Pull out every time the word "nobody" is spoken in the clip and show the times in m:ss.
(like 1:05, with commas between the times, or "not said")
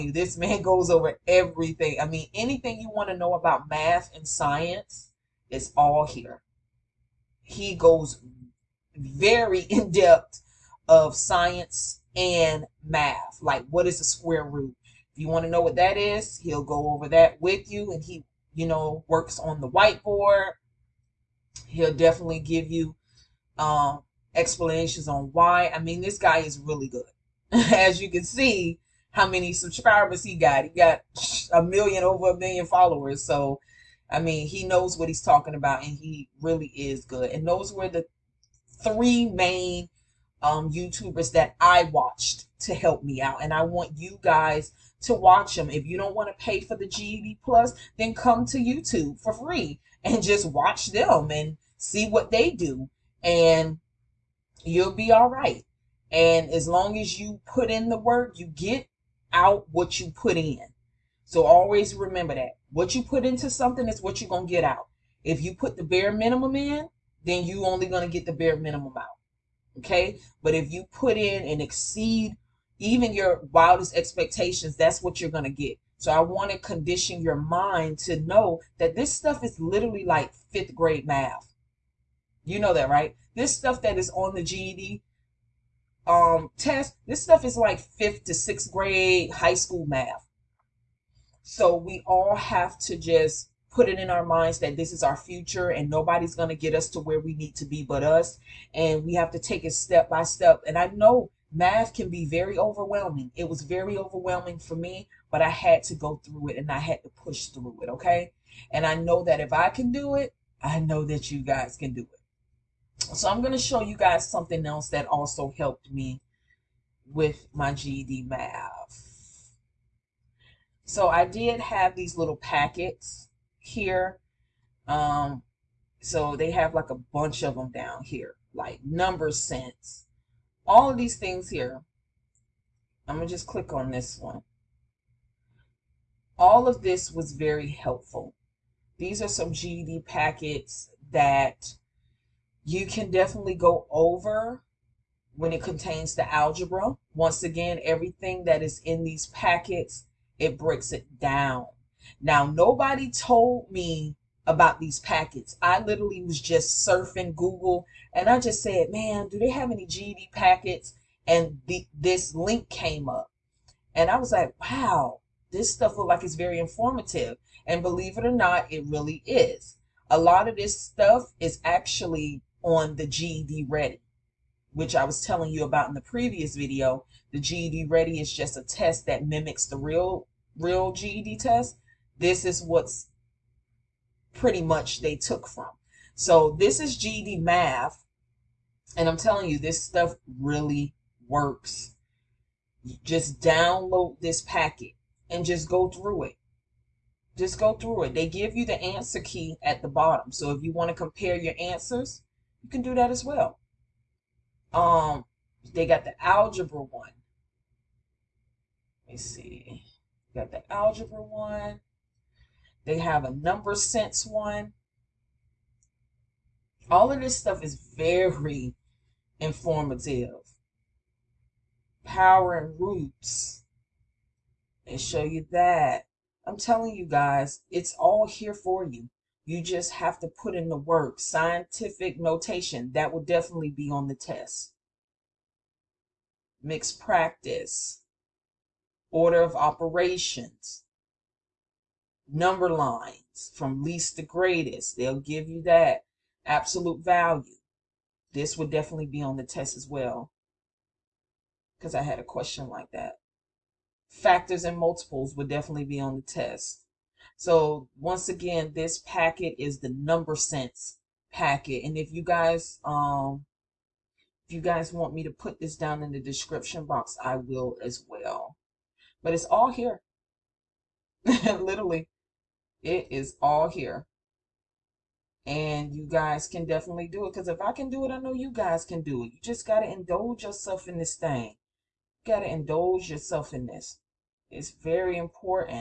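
1:35, 2:32.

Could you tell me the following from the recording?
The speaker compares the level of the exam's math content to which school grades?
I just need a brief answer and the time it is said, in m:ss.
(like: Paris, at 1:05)
fifth to sixth grade, at 1:27.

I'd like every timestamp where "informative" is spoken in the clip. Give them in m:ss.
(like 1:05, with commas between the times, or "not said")
2:46, 3:39.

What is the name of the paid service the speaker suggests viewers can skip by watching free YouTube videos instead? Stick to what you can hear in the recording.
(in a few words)
GED Plus.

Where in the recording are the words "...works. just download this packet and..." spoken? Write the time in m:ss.
3:11.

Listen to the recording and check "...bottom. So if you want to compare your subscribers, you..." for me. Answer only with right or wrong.
wrong.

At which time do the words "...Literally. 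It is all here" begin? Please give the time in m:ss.
4:31.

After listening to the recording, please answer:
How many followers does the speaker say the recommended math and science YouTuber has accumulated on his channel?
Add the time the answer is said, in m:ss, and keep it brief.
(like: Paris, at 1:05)
over a million, at 0:32.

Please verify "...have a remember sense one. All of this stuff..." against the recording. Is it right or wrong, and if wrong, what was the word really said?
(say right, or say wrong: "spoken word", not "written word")
wrong: "number", not "remember".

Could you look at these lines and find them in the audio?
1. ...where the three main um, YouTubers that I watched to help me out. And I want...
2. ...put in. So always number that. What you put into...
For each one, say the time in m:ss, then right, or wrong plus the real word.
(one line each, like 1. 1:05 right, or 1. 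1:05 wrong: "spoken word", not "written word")
1. 0:37 right
2. 1:00 wrong: "remember", not "number".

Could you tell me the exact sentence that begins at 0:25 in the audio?
I mean, this guy is really good.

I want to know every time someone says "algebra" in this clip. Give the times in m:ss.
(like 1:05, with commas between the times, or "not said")
2:26, 3:26, 3:30.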